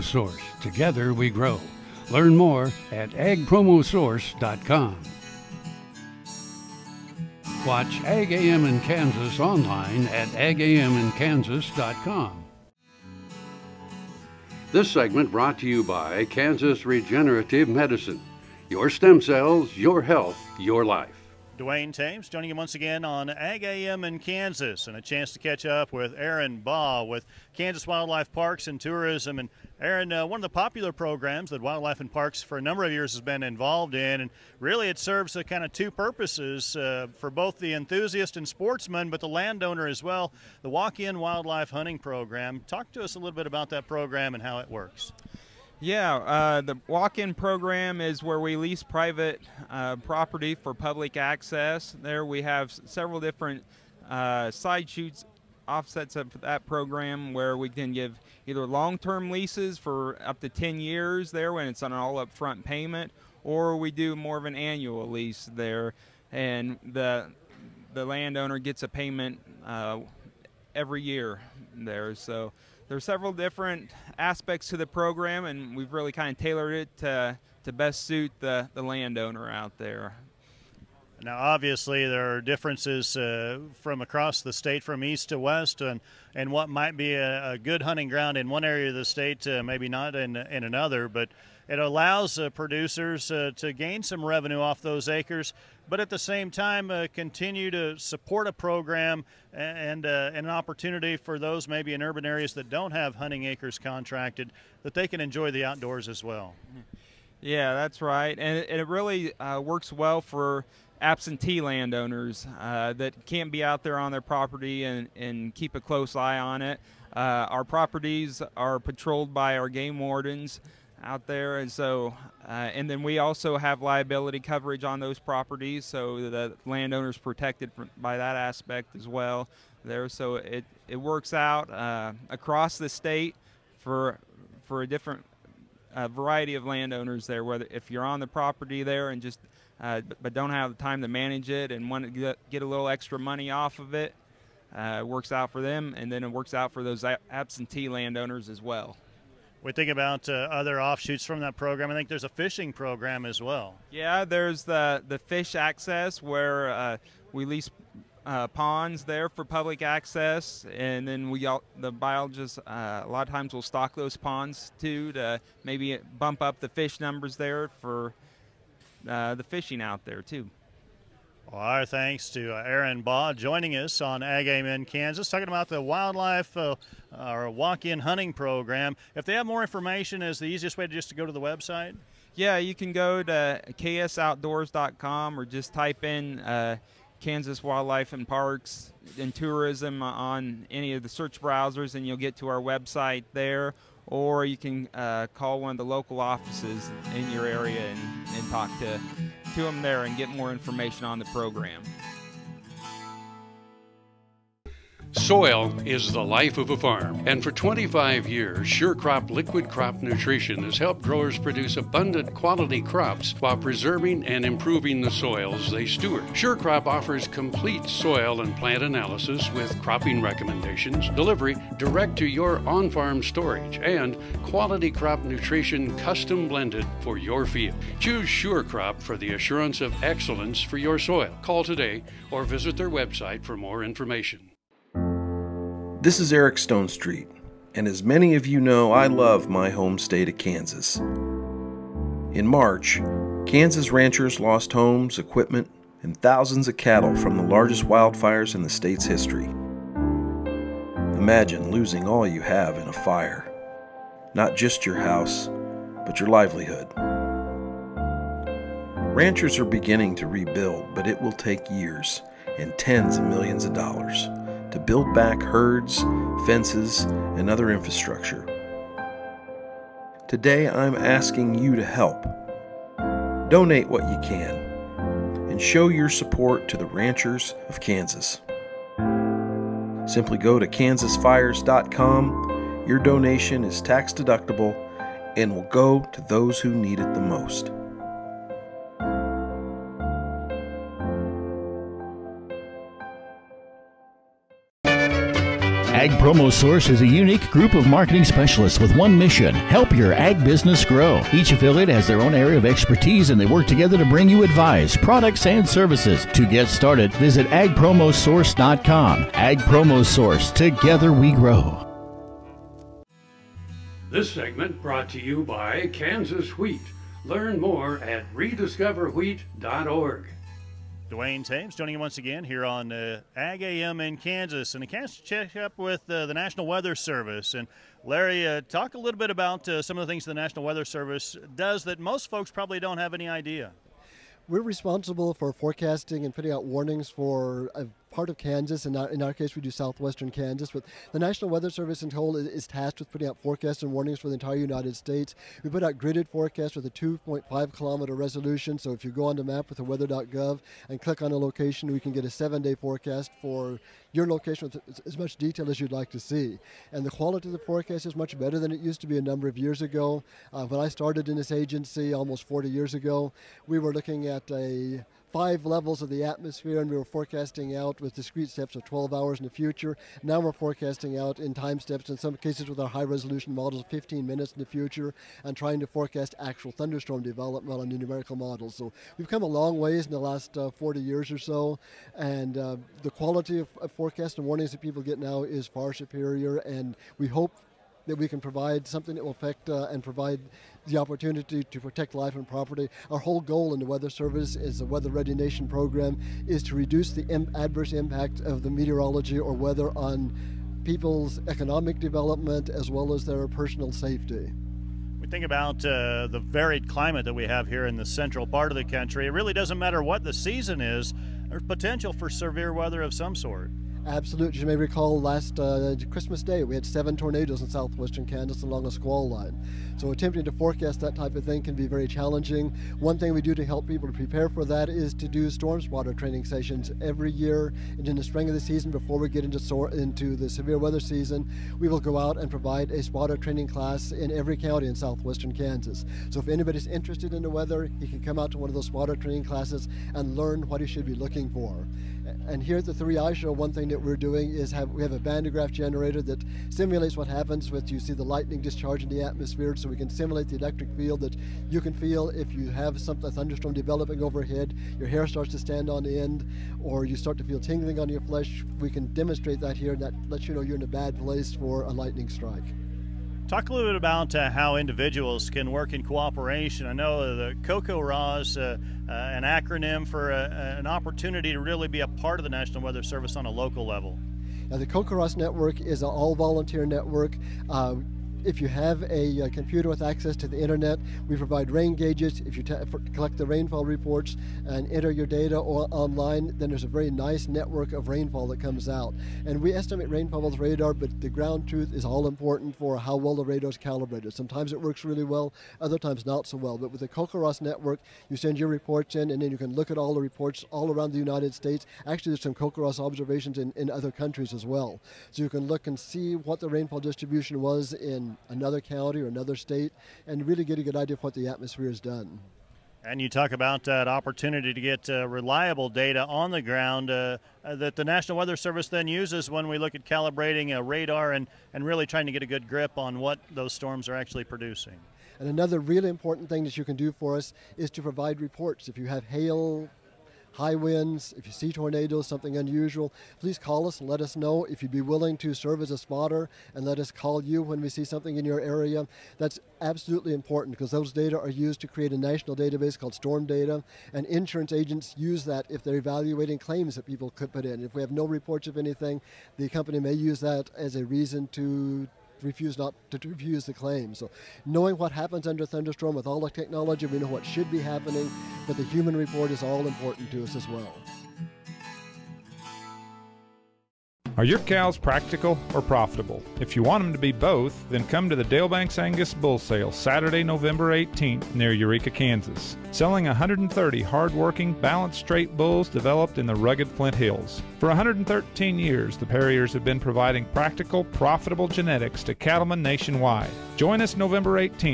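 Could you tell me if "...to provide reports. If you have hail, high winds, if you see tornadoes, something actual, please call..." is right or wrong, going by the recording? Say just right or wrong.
wrong.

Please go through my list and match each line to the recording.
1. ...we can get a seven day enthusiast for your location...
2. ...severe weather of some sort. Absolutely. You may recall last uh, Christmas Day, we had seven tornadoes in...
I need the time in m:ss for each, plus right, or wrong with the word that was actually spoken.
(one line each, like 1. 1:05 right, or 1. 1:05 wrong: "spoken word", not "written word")
1. 5:51 wrong: "forecast", not "enthusiast"
2. 6:52 right.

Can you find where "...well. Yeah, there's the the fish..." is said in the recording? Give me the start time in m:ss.
2:33.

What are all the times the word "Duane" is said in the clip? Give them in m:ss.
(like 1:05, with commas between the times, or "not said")
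0:21, 5:21.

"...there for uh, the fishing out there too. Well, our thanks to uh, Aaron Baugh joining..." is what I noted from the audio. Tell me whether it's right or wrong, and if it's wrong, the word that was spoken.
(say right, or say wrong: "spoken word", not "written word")
right.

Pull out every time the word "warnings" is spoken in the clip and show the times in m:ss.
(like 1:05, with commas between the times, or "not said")
5:36, 5:43, 6:24.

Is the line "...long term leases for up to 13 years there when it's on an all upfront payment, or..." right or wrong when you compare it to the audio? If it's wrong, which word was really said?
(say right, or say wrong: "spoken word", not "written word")
wrong: "10", not "13".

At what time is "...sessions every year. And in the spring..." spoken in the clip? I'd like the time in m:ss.
7:06.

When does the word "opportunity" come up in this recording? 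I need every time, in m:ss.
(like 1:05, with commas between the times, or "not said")
1:40, 6:30, 7:50, 8:34.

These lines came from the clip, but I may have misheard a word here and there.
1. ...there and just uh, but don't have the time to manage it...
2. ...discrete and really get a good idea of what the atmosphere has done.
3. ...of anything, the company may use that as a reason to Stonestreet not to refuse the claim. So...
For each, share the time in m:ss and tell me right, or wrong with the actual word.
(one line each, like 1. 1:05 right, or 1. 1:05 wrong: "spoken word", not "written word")
1. 2:18 right
2. 8:29 wrong: "state", not "discrete"
3. 9:08 wrong: "Refuse", not "Stonestreet".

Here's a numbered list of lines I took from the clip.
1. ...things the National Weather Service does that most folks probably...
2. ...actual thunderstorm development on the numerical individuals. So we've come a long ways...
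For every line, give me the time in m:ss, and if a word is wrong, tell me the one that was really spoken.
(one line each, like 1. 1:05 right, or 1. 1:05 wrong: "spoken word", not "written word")
1. 5:30 right
2. 6:16 wrong: "models", not "individuals".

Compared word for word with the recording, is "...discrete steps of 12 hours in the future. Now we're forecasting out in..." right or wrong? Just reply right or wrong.
right.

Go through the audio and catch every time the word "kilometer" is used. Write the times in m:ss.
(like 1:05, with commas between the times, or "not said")
5:47.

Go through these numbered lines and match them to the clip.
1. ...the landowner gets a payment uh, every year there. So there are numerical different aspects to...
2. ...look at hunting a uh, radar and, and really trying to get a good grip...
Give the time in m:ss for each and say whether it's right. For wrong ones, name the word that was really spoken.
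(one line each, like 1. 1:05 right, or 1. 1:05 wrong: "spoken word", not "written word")
1. 1:07 wrong: "several", not "numerical"
2. 8:39 wrong: "calibrating", not "hunting".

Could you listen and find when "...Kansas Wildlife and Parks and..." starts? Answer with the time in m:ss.
3:07.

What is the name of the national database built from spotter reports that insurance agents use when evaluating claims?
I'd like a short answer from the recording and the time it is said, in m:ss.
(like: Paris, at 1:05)
storm data, at 9:03.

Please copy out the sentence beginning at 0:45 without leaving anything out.
Yeah, uh, the walk in program is where we lease private uh, property for public access.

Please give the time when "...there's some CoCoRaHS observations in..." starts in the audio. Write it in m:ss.
8:22.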